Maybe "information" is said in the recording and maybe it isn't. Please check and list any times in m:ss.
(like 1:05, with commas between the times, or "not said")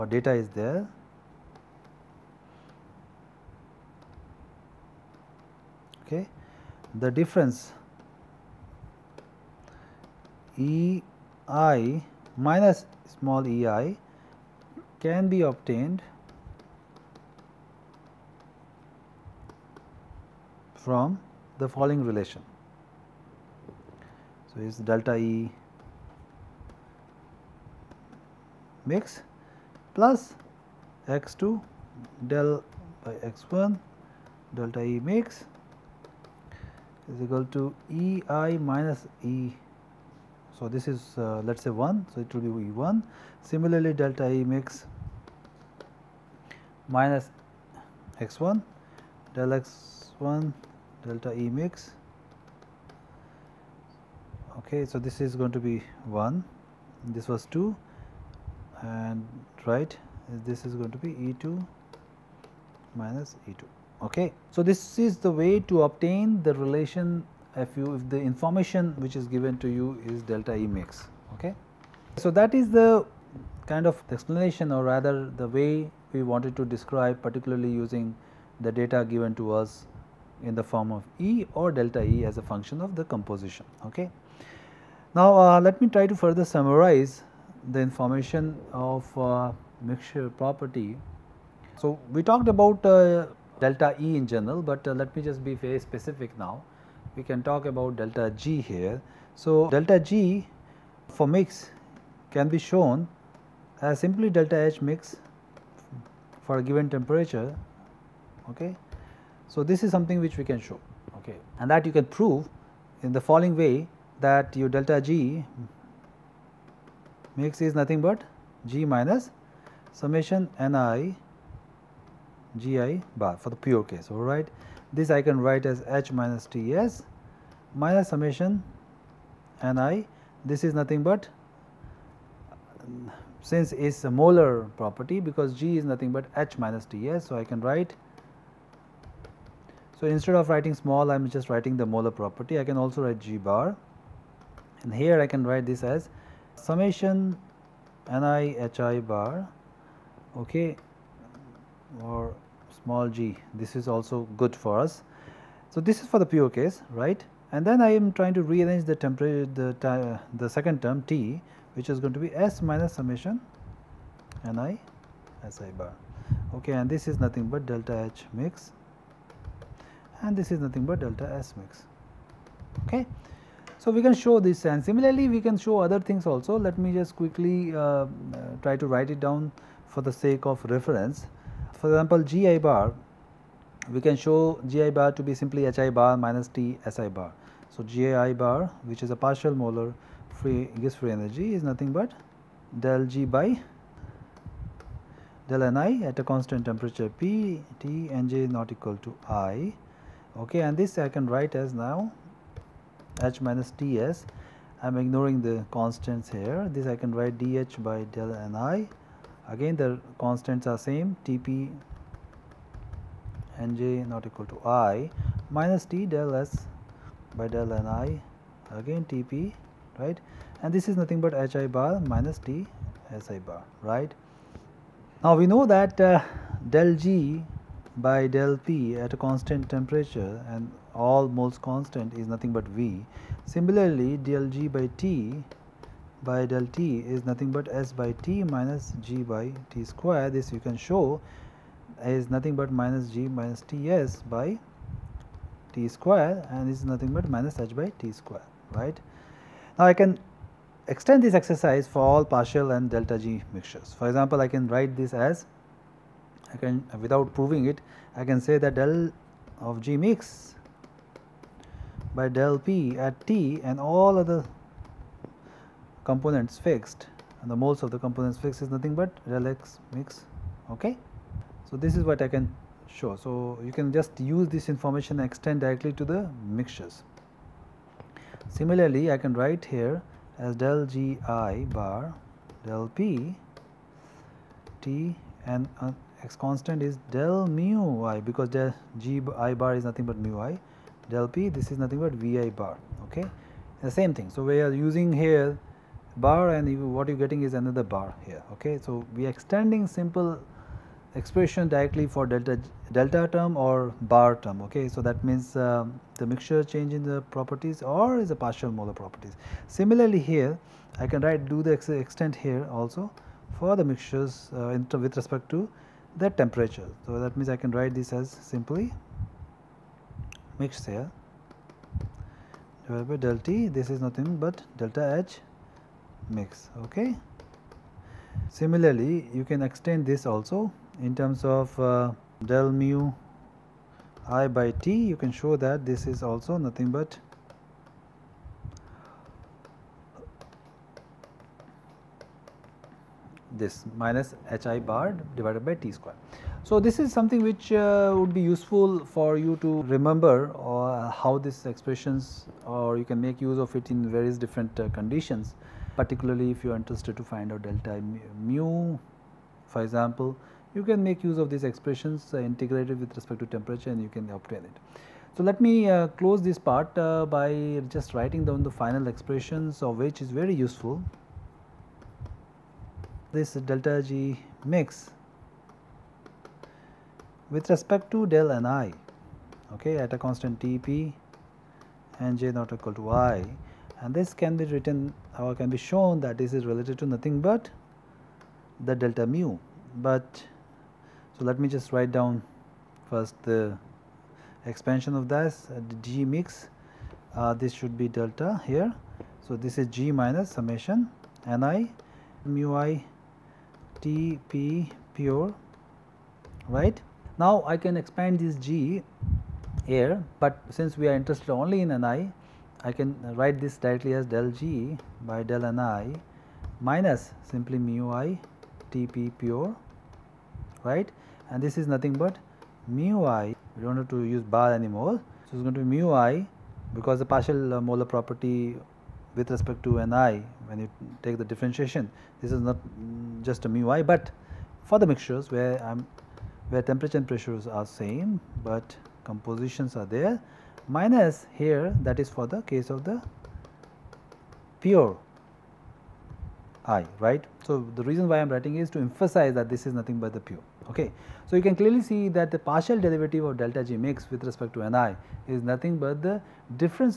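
1:08, 1:27, 4:34.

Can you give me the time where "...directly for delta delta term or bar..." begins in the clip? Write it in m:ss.
5:01.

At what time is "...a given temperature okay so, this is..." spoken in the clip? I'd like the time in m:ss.
1:46.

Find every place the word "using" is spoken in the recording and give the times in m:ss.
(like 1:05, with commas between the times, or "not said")
1:17, 4:54.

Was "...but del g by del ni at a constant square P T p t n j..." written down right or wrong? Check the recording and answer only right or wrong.
wrong.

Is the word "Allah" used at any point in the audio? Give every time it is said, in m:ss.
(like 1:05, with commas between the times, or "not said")
not said.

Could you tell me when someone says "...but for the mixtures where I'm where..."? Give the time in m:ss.
7:14.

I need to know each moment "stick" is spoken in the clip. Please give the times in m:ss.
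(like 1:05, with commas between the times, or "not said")
not said.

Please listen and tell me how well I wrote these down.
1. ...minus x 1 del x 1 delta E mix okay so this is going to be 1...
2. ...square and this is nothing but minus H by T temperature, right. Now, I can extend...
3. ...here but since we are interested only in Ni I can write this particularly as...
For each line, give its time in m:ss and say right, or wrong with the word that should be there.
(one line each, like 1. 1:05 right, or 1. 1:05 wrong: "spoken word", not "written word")
1. 0:46 right
2. 4:05 wrong: "square", not "temperature"
3. 6:49 wrong: "directly", not "particularly".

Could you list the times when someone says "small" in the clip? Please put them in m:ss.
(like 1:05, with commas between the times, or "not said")
0:13, 2:20, 2:32.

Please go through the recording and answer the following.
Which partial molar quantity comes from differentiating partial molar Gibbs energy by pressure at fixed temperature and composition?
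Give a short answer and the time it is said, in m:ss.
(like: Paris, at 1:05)
vi bar, at 4:52.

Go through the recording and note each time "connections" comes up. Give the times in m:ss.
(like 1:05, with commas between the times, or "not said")
not said.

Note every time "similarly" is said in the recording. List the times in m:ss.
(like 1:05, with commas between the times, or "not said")
0:43, 2:54, 3:53, 4:38, 5:09, 5:28.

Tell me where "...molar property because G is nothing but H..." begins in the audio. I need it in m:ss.
2:14.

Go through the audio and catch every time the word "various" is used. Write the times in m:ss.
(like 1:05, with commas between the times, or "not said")
5:54.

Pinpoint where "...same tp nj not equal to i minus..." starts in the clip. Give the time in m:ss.
3:30.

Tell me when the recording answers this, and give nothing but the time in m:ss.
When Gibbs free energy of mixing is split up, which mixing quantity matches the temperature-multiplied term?
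2:50.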